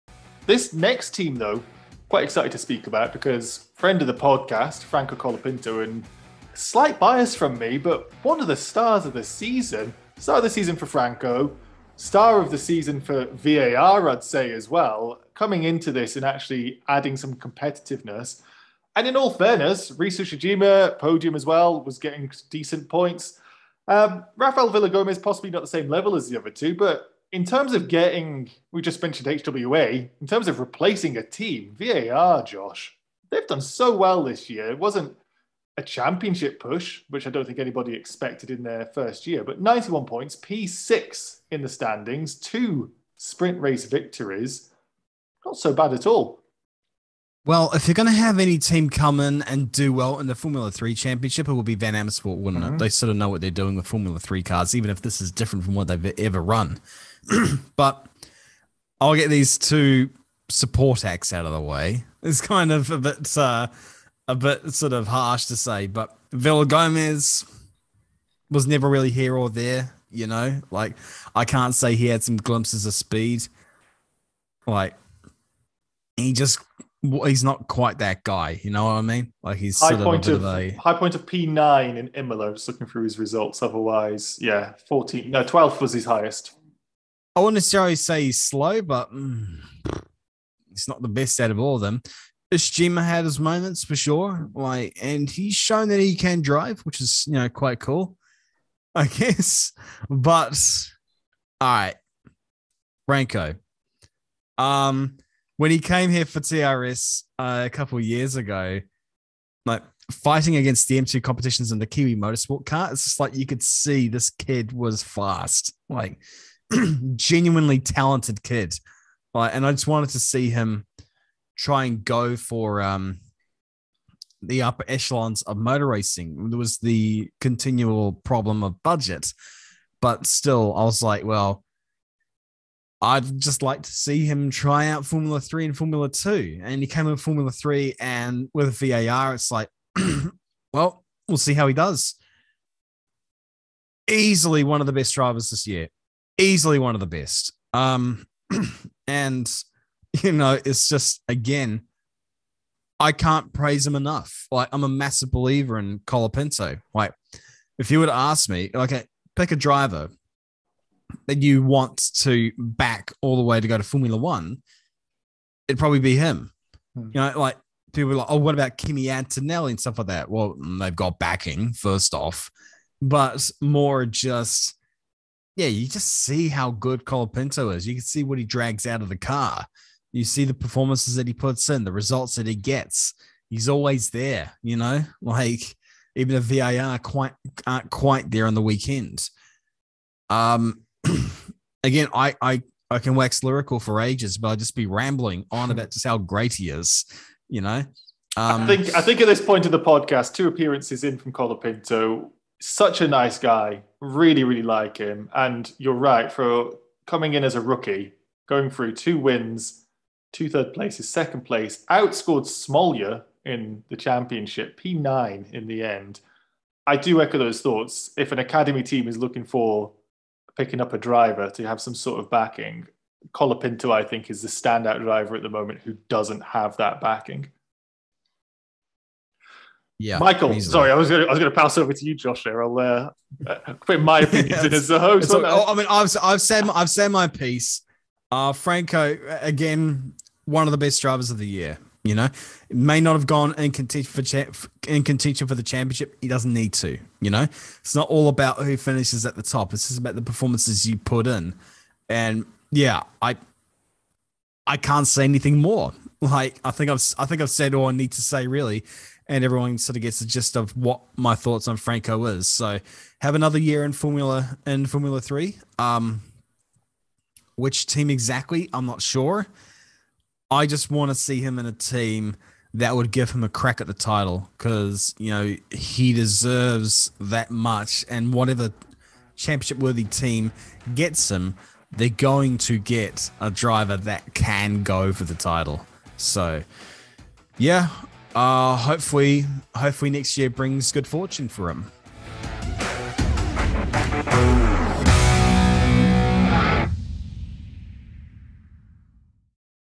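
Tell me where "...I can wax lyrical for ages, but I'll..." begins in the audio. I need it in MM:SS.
03:12.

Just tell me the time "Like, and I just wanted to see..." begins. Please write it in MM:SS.
01:59.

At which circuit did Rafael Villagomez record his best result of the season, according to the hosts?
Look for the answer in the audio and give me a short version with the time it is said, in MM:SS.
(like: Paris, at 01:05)
Imola, at 01:22.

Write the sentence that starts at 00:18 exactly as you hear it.
And in all fairness, Reece Ushijima, podium as well, was getting decent points.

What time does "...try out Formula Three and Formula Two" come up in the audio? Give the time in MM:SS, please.
02:14.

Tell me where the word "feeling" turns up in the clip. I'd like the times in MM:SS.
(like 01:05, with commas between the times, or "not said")
not said.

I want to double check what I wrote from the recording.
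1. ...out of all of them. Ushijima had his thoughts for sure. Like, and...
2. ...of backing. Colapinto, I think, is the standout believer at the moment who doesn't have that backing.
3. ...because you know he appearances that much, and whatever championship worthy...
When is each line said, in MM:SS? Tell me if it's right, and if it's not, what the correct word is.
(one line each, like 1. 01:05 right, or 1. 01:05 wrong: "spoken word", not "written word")
1. 01:31 wrong: "moments", not "thoughts"
2. 03:42 wrong: "driver", not "believer"
3. 04:34 wrong: "deserves", not "appearances".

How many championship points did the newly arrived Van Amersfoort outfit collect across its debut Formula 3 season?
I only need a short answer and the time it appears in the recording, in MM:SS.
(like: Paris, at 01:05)
91, at 00:39.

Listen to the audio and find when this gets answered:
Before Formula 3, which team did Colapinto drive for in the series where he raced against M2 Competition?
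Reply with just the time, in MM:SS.
01:51.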